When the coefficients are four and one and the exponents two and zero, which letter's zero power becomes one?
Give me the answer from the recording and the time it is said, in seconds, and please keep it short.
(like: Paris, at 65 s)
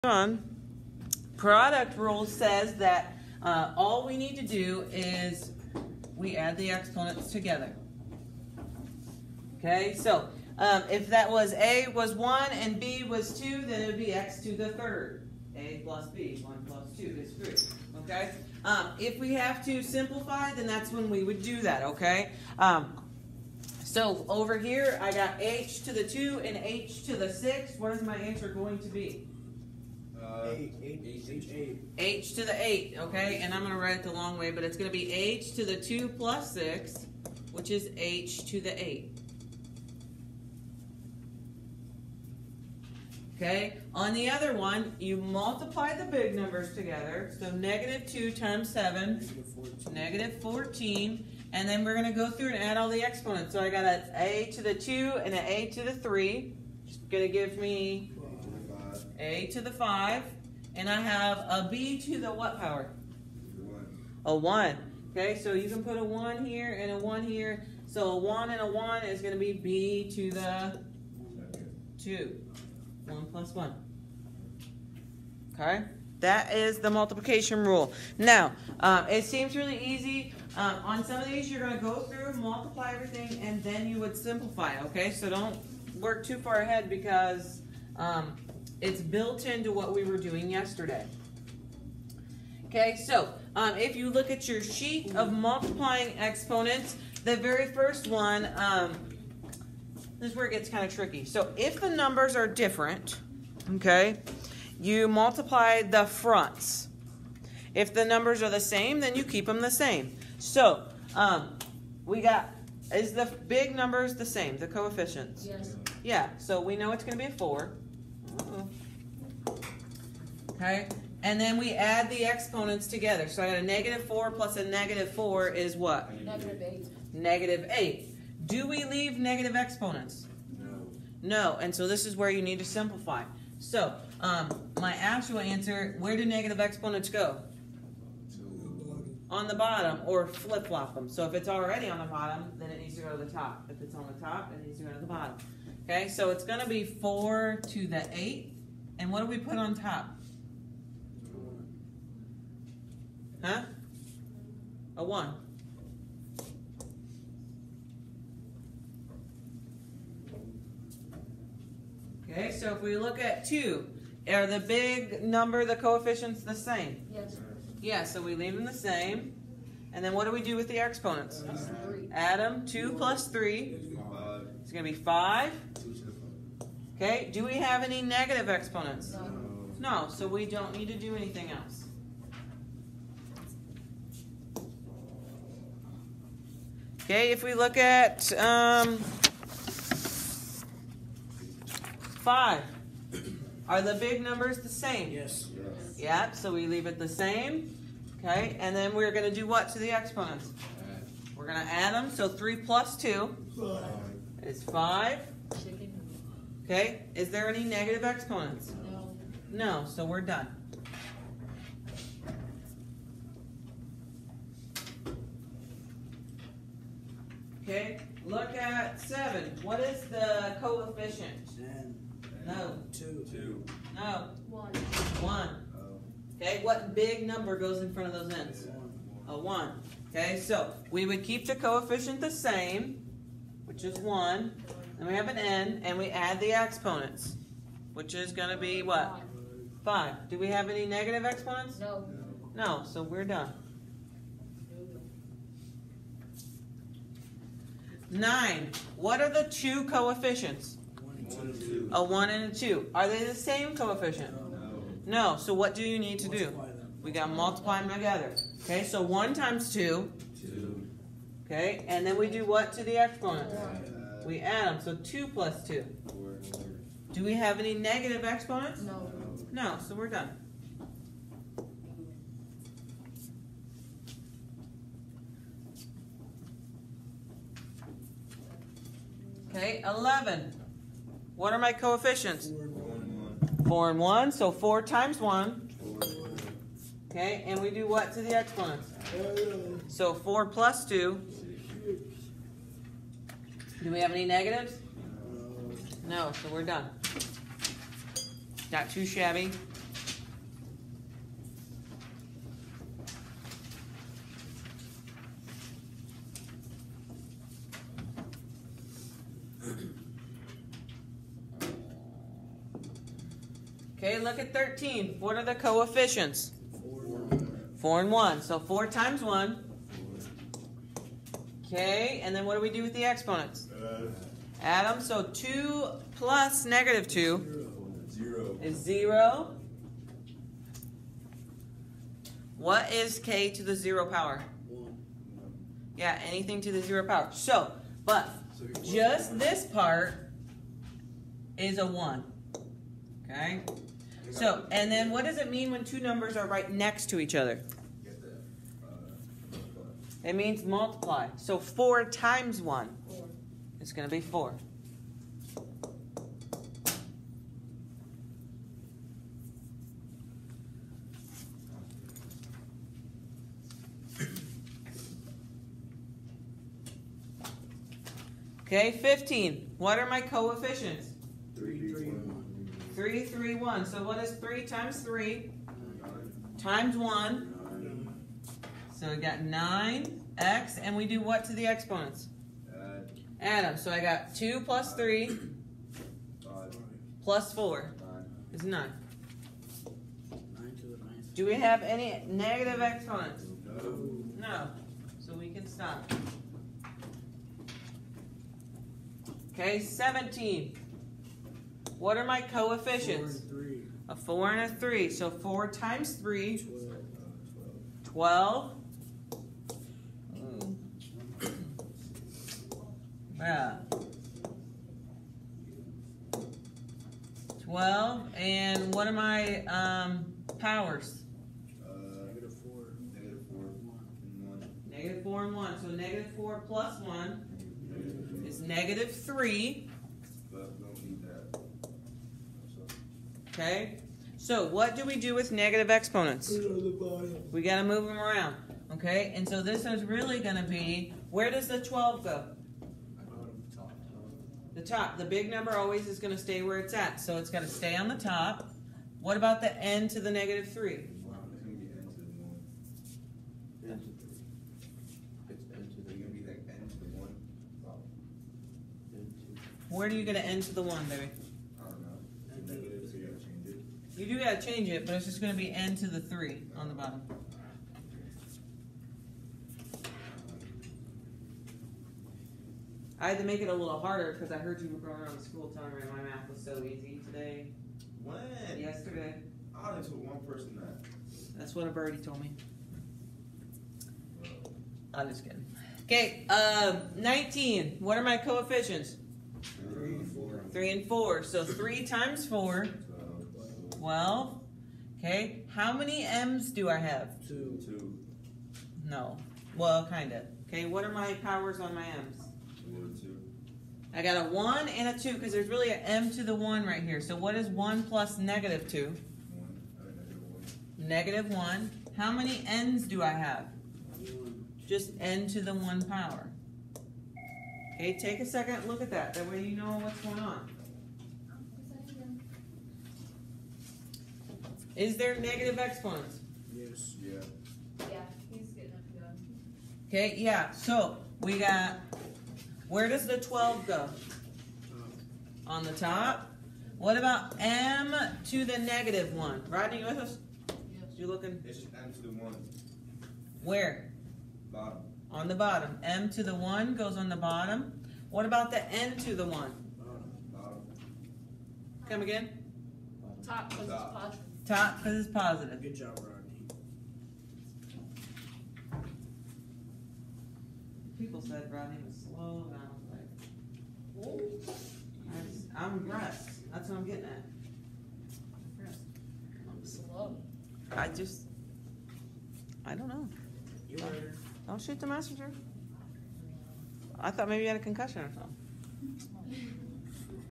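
k, at 333 s.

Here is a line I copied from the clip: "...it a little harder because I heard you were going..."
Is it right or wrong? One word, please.
right.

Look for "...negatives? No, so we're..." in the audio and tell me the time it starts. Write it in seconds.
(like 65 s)
294 s.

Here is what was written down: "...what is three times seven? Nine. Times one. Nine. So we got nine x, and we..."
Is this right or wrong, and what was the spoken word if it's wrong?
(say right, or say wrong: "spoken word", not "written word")
wrong: "three", not "seven".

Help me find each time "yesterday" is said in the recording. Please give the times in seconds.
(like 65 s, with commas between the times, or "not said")
90 s, 478 s.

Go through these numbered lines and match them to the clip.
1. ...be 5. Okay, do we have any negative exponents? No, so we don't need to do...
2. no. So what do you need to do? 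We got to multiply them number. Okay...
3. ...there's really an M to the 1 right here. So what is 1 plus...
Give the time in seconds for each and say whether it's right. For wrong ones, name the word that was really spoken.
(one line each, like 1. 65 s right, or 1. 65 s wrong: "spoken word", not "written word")
1. 174 s right
2. 255 s wrong: "together", not "number"
3. 505 s right.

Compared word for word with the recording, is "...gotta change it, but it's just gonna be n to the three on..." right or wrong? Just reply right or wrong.
right.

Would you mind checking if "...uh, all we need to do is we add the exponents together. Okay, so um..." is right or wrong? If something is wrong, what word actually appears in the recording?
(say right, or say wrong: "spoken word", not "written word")
right.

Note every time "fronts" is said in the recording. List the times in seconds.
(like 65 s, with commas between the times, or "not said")
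106 s, 227 s.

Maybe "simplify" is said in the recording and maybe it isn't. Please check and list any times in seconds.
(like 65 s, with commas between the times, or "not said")
19 s, 84 s, 132 s.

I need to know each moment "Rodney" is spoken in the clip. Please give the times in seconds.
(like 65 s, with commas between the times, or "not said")
539 s, 556 s, 561 s.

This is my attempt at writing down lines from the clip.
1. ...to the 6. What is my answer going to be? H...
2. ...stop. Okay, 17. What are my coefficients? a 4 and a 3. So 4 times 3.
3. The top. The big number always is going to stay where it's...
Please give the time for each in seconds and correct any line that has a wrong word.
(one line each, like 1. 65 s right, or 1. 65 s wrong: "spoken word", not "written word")
1. 27 s right
2. 395 s right
3. 444 s right.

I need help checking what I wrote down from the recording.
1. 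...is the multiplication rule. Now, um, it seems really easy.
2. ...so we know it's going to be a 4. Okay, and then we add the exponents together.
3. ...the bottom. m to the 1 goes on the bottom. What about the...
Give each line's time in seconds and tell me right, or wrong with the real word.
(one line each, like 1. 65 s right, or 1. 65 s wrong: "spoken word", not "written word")
1. 76 s right
2. 116 s right
3. 545 s right.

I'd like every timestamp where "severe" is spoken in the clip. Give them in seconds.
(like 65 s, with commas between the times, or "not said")
not said.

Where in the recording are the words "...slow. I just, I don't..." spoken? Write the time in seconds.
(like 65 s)
569 s.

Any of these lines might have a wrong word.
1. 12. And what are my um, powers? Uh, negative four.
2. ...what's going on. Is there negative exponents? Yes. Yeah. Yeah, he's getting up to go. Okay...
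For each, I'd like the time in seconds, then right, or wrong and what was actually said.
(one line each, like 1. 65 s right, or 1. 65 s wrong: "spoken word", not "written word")
1. 417 s right
2. 520 s right.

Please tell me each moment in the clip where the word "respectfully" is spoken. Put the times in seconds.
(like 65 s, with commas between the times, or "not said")
not said.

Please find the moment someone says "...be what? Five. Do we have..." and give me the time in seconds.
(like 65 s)
238 s.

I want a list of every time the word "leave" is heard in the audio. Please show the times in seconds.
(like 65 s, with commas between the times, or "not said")
128 s, 168 s, 196 s.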